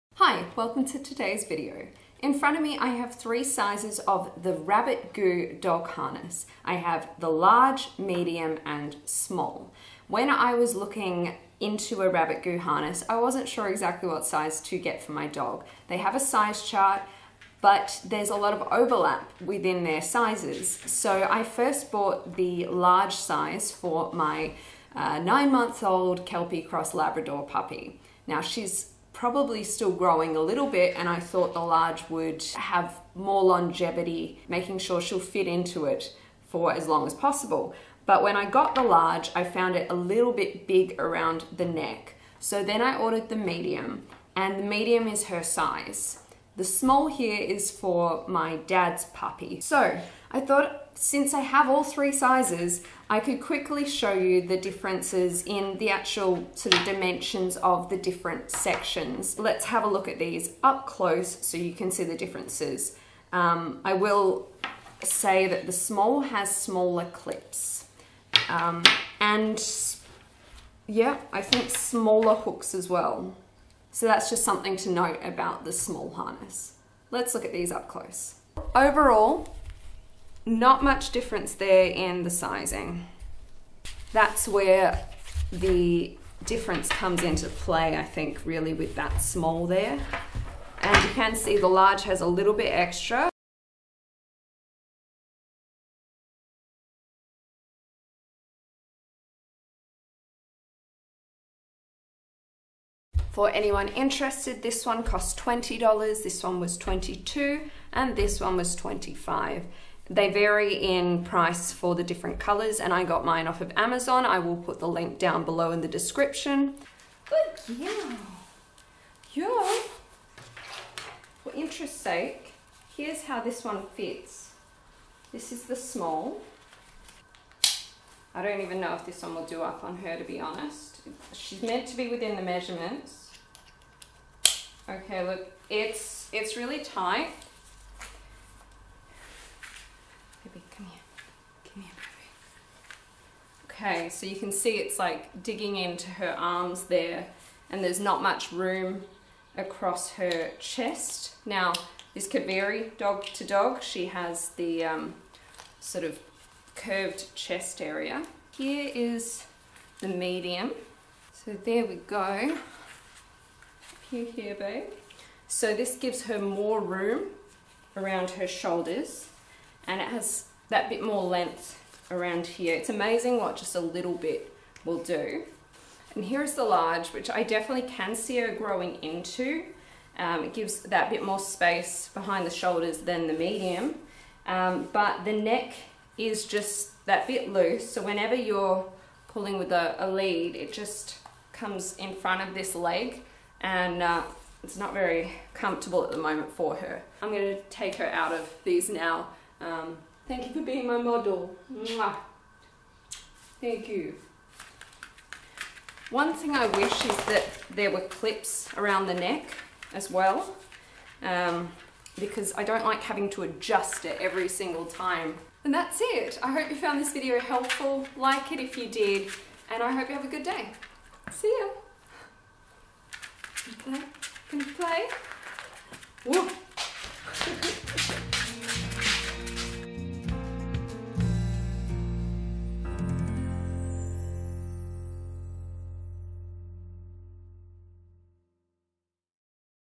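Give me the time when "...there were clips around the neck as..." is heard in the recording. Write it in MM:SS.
03:27.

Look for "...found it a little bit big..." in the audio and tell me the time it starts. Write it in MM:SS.
00:39.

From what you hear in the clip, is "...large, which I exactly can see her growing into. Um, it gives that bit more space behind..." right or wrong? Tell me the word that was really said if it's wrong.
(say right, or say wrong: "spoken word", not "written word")
wrong: "definitely", not "exactly".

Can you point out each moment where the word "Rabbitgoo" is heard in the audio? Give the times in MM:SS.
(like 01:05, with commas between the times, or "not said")
00:04, 00:12.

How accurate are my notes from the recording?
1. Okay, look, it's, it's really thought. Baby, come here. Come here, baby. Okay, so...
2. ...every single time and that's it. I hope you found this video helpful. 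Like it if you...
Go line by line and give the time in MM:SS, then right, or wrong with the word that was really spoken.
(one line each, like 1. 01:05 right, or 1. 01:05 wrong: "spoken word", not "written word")
1. 02:14 wrong: "tight", not "thought"
2. 03:34 right.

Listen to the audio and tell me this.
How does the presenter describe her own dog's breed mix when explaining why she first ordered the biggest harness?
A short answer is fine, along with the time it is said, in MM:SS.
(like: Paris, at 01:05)
Kelpie Cross Labrador, at 00:26.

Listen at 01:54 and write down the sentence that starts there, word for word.
I will put the link down below in the description.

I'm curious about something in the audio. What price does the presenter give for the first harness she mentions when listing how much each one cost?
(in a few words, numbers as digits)
$20.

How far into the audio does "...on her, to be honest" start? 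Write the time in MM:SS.
02:09.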